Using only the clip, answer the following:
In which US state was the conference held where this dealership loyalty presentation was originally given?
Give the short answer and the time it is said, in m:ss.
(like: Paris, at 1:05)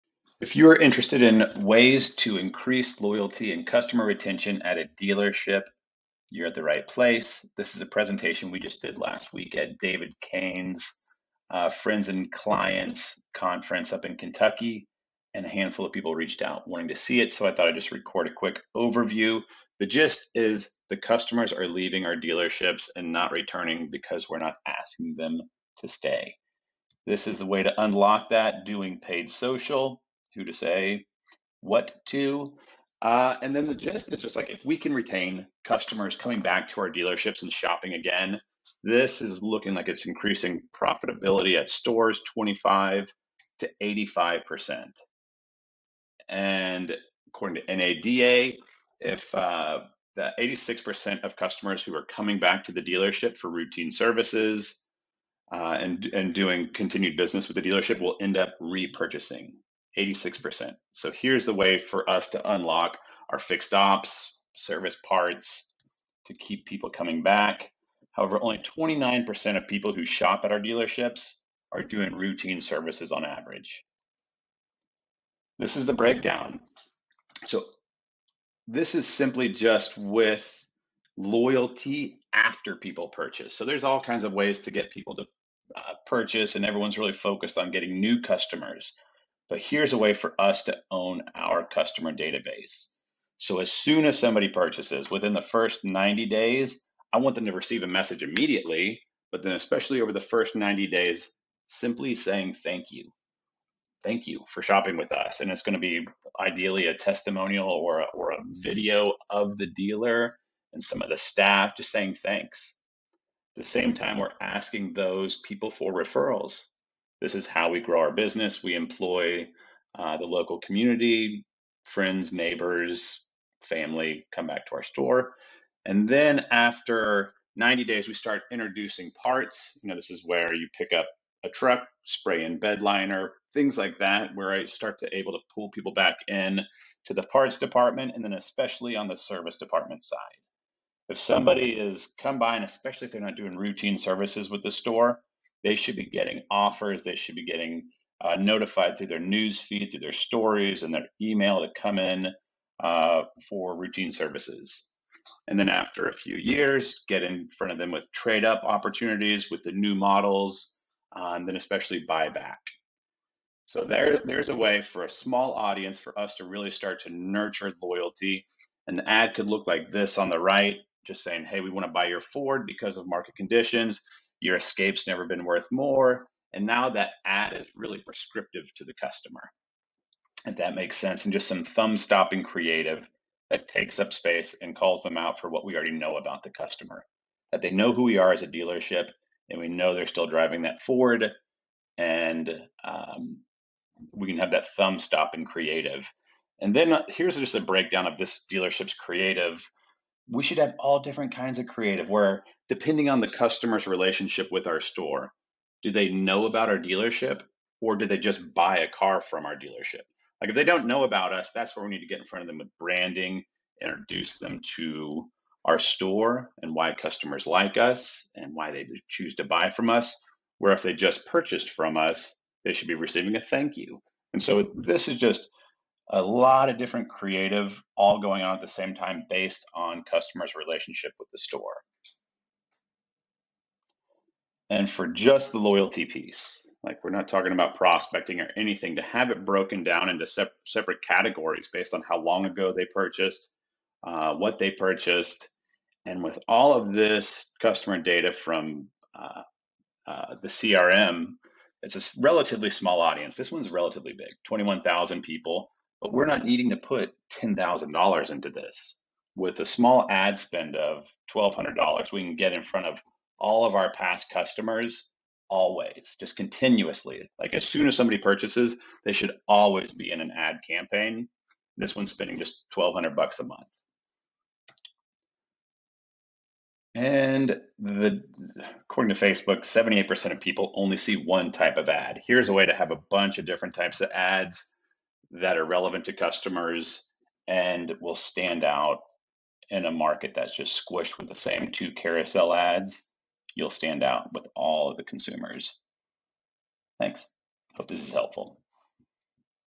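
Kentucky, at 0:14.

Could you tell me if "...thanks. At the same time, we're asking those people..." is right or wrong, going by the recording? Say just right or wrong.
right.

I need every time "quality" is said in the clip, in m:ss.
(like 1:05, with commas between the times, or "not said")
not said.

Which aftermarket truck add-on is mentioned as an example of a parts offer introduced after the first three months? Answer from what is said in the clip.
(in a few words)
spray in bed liner.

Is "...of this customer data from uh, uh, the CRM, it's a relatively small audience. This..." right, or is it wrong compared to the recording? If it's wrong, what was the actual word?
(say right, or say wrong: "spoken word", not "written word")
right.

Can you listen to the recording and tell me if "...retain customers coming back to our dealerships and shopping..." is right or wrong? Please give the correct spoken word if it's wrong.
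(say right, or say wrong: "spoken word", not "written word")
right.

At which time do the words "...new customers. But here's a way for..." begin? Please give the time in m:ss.
1:27.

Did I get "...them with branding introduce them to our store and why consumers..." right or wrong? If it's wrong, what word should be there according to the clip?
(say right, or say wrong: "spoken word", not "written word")
wrong: "customers", not "consumers".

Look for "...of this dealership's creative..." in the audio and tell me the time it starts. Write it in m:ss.
3:18.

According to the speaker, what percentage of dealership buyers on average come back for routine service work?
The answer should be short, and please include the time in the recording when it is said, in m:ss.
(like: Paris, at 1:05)
29%, at 1:08.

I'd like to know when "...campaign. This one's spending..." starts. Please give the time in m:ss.
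4:30.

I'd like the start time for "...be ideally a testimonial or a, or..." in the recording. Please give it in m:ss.
1:45.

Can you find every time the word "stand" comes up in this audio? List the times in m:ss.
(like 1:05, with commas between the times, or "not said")
4:48, 4:53.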